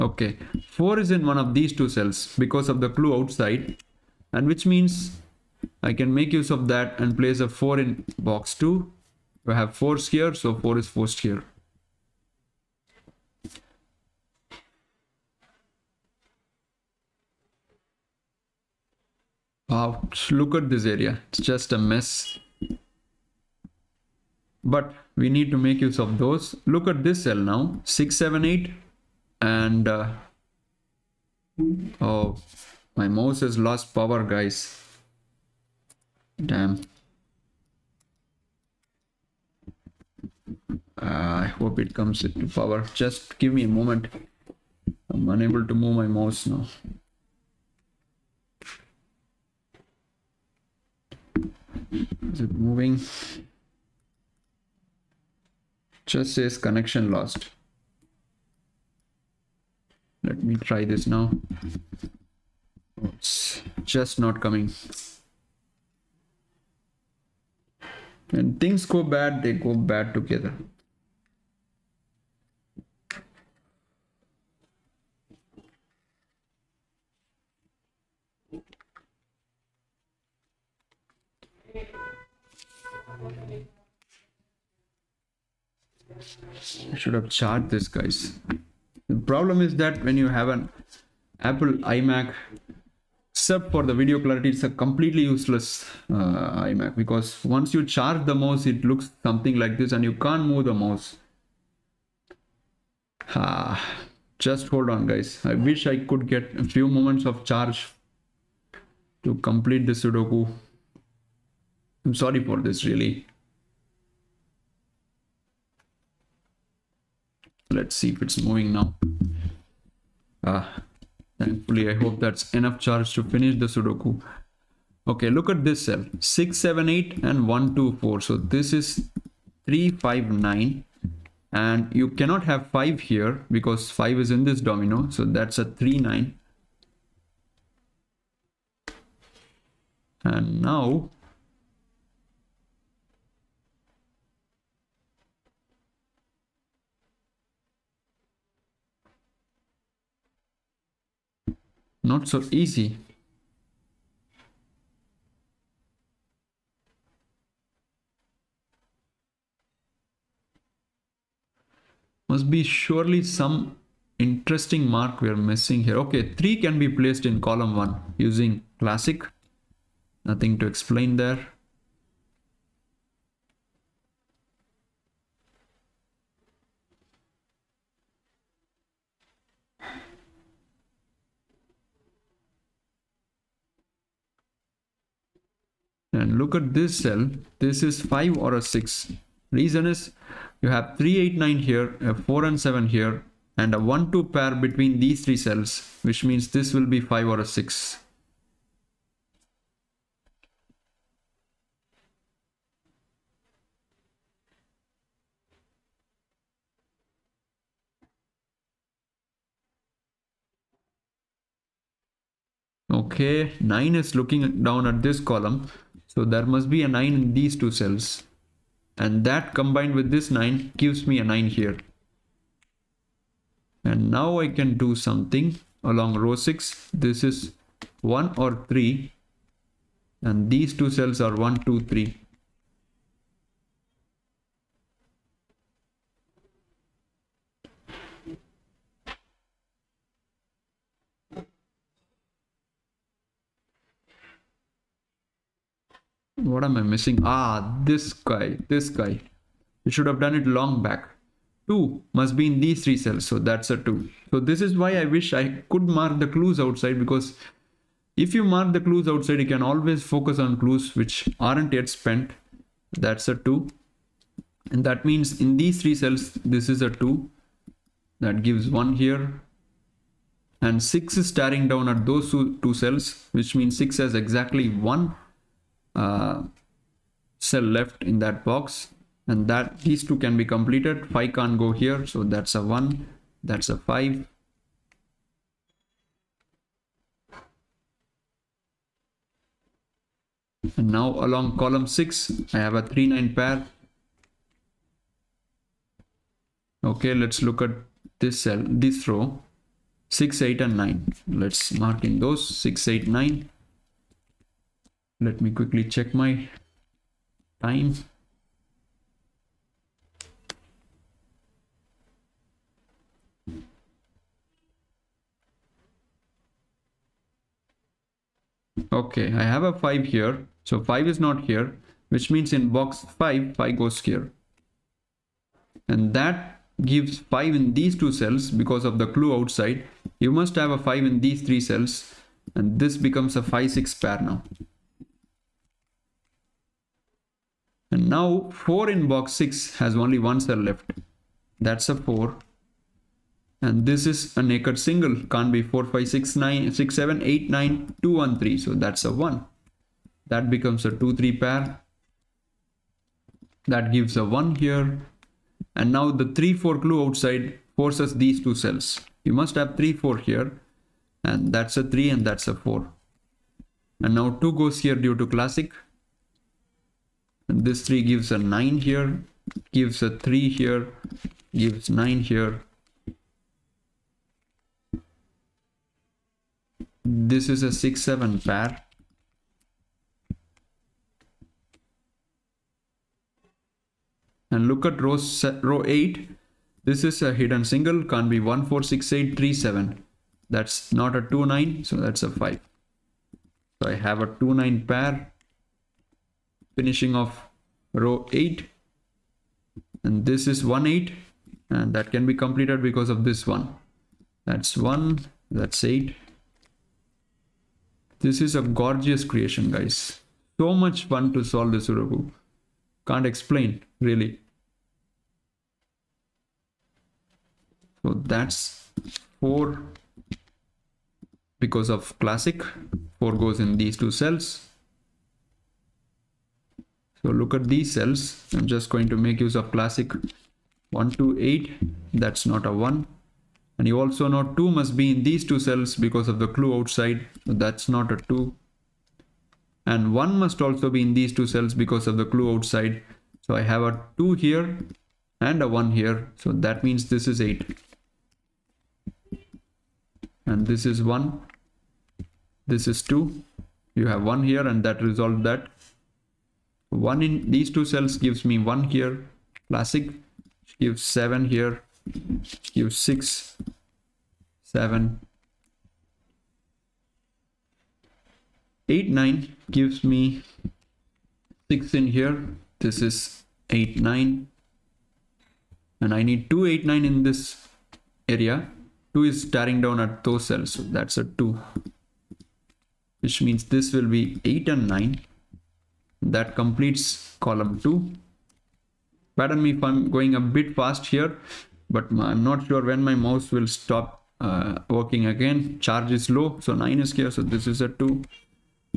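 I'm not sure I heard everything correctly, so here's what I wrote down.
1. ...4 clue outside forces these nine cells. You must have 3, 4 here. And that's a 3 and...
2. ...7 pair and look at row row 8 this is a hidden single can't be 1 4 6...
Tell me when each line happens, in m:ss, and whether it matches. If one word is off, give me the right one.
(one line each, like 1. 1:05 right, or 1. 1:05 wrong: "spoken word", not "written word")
1. 5:56 wrong: "two", not "nine"
2. 6:18 right.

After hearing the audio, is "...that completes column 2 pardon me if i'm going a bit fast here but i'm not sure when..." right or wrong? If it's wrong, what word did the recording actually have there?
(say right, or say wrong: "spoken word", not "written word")
right.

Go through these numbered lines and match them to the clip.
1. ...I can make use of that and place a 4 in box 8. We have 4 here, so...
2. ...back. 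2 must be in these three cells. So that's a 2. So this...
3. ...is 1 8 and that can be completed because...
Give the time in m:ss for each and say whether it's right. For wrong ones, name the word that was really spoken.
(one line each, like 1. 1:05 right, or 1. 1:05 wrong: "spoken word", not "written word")
1. 0:05 wrong: "2", not "8"
2. 4:10 right
3. 6:40 right.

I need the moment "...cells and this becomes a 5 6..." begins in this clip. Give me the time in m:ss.
5:31.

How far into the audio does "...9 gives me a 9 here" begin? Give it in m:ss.
3:40.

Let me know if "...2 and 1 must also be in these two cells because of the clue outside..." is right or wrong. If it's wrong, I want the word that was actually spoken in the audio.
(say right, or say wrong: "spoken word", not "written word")
right.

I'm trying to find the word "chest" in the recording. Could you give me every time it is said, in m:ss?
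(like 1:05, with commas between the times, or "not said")
not said.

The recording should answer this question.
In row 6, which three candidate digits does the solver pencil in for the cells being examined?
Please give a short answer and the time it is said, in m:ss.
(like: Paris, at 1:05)
6, 8, 9, at 5:02.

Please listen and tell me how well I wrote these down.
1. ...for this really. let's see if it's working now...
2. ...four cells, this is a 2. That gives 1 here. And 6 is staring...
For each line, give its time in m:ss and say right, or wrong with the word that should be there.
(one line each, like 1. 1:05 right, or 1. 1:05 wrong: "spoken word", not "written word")
1. 1:52 wrong: "moving", not "working"
2. 4:25 wrong: "three", not "four".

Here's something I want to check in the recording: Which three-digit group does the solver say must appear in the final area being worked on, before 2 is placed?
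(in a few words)
2, 8, 9.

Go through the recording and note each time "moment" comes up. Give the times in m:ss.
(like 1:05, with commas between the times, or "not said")
0:43, 1:46.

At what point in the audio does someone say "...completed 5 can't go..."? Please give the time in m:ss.
4:40.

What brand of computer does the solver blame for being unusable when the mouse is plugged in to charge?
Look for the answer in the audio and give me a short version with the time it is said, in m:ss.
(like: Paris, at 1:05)
Apple iMac, at 1:31.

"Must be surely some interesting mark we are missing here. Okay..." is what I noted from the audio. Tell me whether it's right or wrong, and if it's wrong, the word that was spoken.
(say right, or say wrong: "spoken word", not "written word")
right.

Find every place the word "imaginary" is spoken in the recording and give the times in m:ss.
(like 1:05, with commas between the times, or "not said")
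not said.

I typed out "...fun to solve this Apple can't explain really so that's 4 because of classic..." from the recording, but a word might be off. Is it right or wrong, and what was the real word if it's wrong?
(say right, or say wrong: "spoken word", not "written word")
wrong: "Sudoku", not "Apple".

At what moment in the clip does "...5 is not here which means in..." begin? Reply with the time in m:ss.
5:20.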